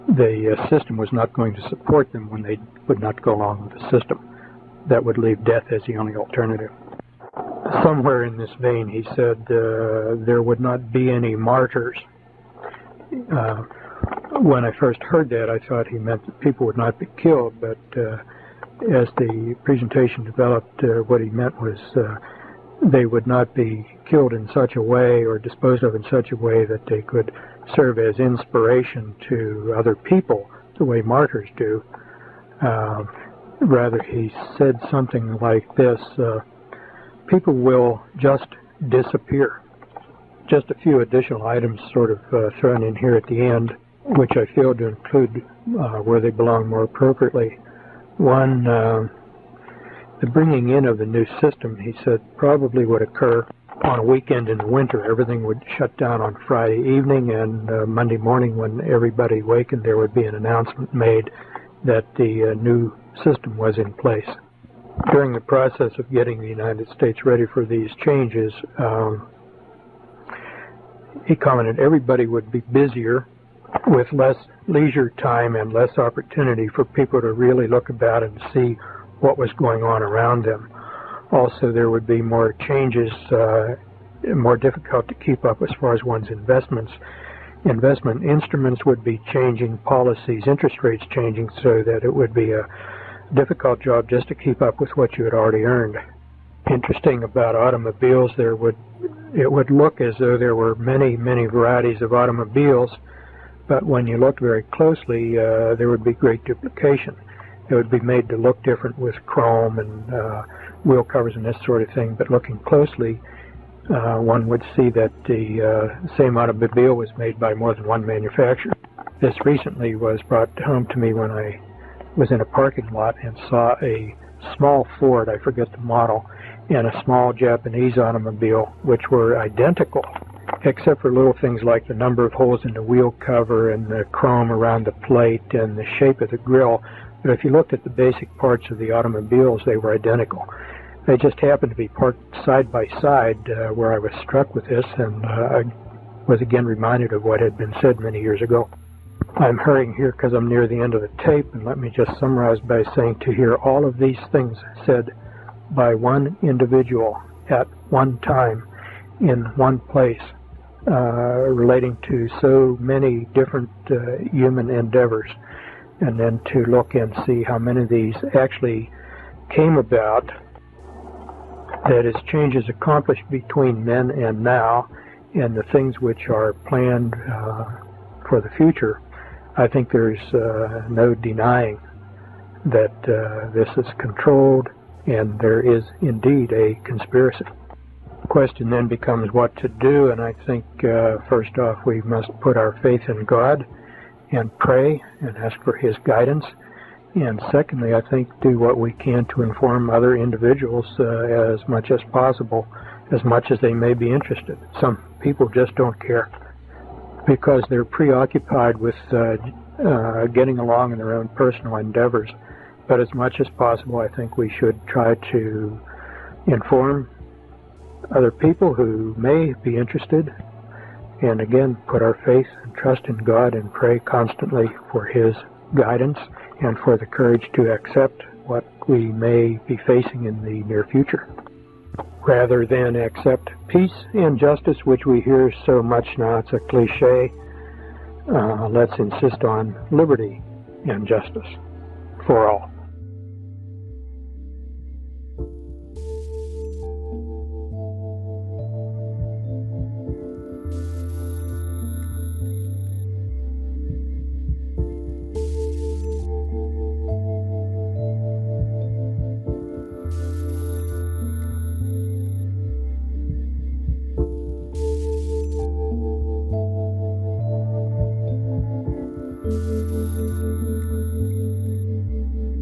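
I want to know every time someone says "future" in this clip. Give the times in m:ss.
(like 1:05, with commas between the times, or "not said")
2:58, 3:50.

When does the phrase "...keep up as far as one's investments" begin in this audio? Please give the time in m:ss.
1:25.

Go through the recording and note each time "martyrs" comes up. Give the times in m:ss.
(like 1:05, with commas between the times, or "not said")
0:11, 0:31.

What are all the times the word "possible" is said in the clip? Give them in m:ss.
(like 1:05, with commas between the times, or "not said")
3:22, 3:33.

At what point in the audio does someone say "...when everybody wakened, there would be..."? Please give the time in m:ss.
0:58.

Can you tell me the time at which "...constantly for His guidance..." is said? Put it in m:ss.
3:43.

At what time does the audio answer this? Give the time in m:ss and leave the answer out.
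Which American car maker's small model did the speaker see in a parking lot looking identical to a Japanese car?
2:04.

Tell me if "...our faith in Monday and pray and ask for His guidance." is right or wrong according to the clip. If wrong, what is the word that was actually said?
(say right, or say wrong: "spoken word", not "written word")
wrong: "God", not "Monday".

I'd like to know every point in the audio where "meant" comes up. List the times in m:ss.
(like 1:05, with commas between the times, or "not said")
0:15, 0:21.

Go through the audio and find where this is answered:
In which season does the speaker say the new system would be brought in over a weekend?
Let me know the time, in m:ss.
0:54.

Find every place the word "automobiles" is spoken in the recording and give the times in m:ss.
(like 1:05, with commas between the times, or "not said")
1:37, 1:42, 1:56, 2:07, 2:18.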